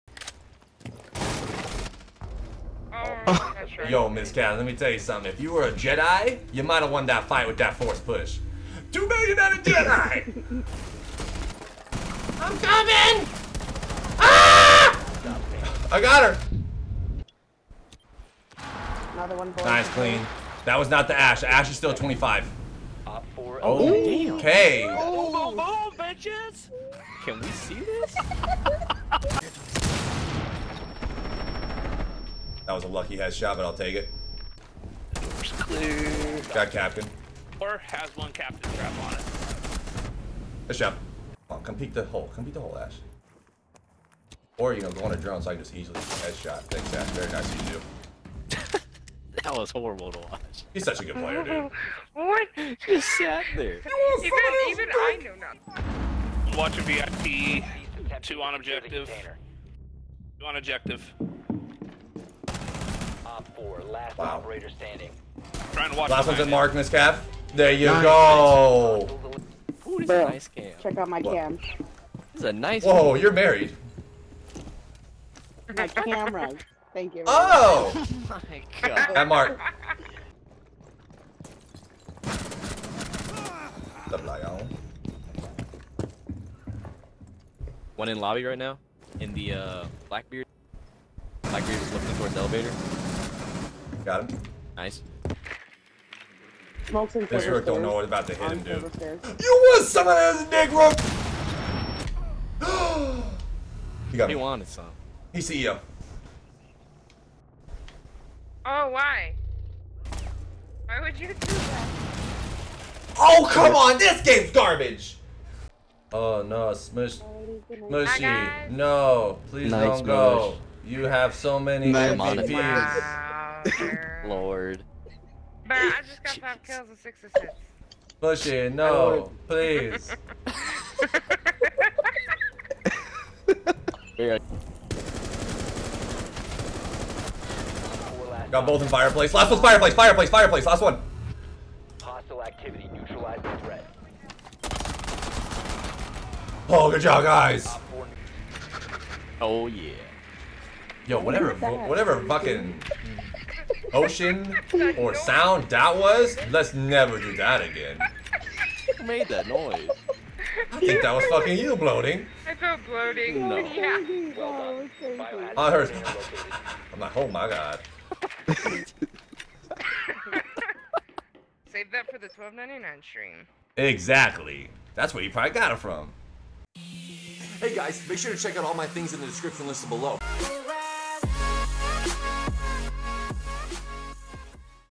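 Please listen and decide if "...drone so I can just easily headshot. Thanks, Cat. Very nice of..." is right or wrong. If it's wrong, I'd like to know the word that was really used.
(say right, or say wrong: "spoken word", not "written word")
wrong: "Ash", not "Cat".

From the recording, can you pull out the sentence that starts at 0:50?
He's such a good player, dude.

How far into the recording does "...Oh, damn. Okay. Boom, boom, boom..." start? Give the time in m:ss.
0:23.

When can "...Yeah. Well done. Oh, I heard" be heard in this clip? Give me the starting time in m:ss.
2:43.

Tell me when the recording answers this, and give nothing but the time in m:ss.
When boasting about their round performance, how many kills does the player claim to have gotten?
2:06.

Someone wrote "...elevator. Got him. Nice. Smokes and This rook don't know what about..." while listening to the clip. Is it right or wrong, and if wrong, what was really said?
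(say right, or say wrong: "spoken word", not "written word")
right.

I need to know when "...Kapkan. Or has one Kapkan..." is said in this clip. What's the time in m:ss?
0:36.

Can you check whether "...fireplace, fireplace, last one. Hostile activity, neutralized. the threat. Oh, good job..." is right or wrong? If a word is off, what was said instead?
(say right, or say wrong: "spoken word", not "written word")
right.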